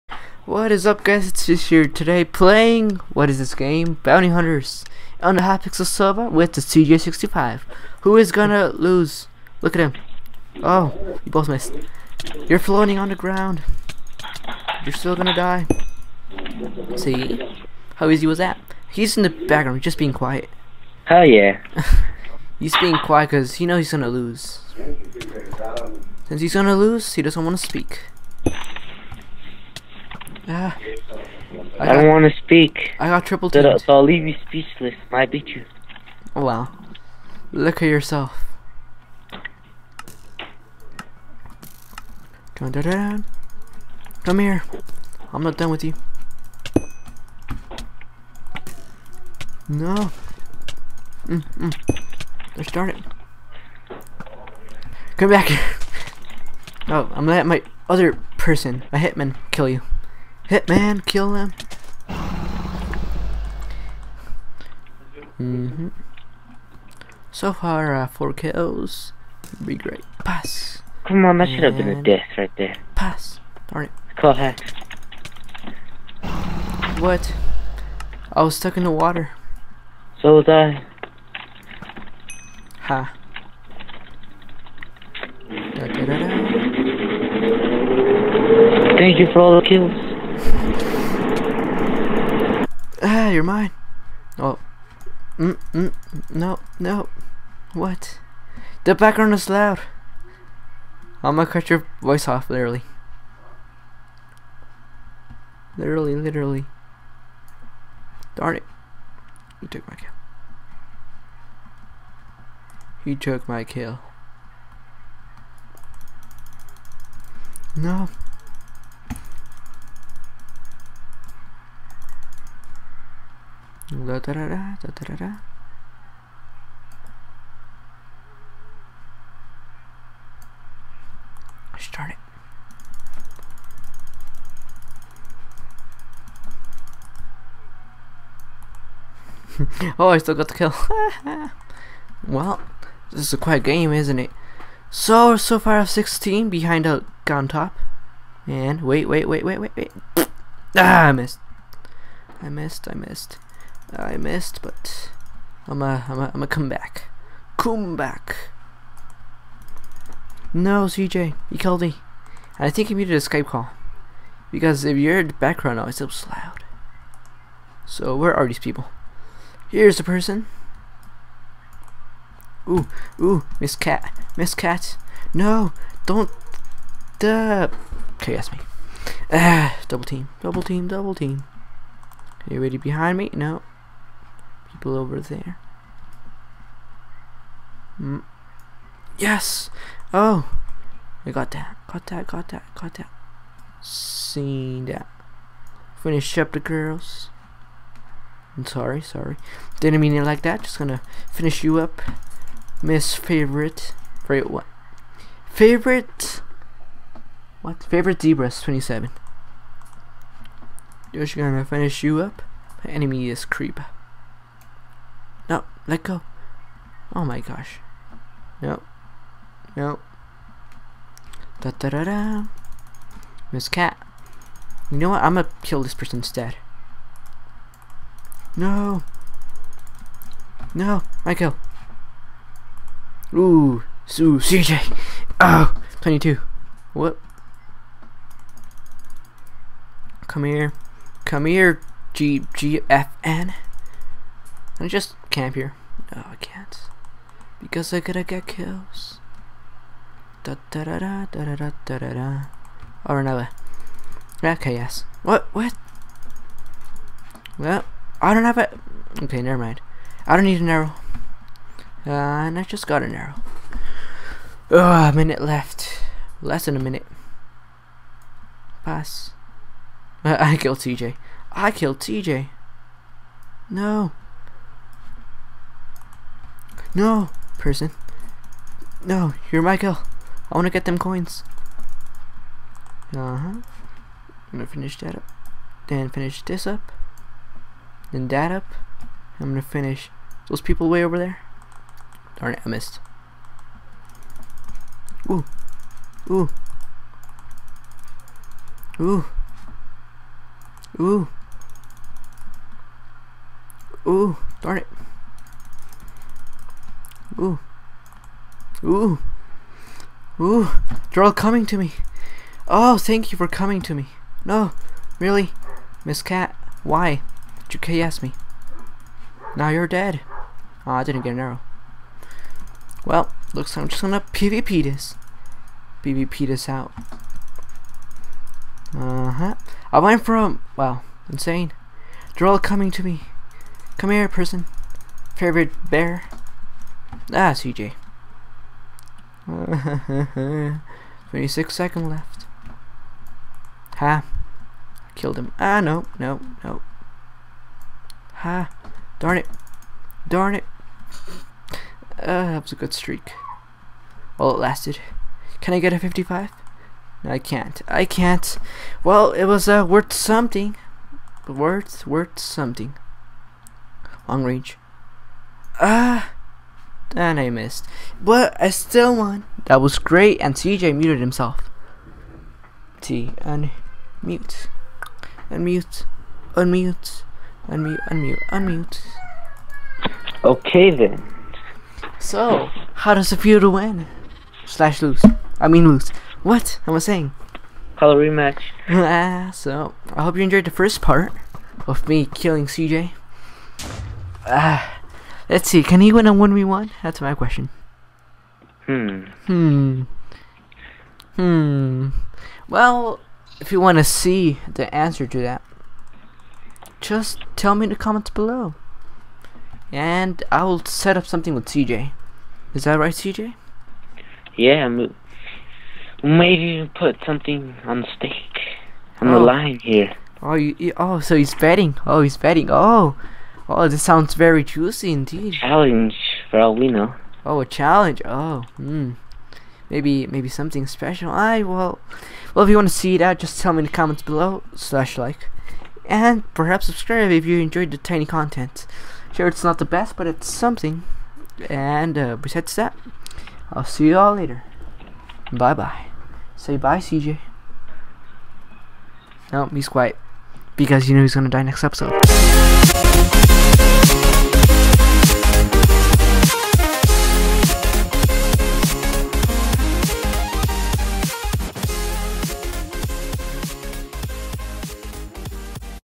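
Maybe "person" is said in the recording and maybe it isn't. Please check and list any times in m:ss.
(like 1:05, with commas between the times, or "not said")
0:58, 2:50, 3:45, 4:37, 5:34.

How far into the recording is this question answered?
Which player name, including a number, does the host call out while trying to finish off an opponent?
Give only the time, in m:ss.
3:28.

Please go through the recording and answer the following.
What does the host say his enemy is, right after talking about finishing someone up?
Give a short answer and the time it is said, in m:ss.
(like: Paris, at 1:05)
Creeper, at 3:33.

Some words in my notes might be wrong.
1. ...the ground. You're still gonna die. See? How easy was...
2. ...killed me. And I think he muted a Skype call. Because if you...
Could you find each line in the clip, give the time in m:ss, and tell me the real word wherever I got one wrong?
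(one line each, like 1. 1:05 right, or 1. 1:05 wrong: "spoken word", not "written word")
1. 0:13 right
2. 2:41 right.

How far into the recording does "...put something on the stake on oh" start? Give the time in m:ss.
6:56.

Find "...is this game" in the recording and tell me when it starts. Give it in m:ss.
0:03.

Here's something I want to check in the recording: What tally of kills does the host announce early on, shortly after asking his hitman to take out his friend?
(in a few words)
4.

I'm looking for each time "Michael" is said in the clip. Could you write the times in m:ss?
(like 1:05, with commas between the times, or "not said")
3:51, 4:39.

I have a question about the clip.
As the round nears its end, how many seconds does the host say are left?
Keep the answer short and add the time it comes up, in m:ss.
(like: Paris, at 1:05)
26, at 5:41.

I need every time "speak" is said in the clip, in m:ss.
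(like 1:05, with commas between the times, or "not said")
0:27, 0:32.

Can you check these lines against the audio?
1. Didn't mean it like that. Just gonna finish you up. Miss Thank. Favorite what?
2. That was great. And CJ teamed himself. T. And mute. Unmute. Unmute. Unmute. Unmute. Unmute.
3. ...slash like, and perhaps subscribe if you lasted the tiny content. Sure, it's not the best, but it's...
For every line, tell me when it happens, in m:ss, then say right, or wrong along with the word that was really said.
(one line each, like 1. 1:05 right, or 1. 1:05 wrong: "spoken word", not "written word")
1. 3:19 wrong: "Favorite", not "Thank"
2. 6:09 wrong: "muted", not "teamed"
3. 7:14 wrong: "enjoyed", not "lasted".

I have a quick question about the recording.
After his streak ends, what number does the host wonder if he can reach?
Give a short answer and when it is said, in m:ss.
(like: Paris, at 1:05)
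55, at 5:55.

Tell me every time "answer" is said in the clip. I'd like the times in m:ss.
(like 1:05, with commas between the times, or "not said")
6:44.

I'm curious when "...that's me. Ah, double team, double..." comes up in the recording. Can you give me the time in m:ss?
2:58.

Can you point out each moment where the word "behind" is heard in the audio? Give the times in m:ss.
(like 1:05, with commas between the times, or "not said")
2:26, 3:02.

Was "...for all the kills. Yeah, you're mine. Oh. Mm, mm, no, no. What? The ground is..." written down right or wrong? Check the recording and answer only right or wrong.
wrong.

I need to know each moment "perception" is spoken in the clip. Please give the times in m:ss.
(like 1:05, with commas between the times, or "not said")
not said.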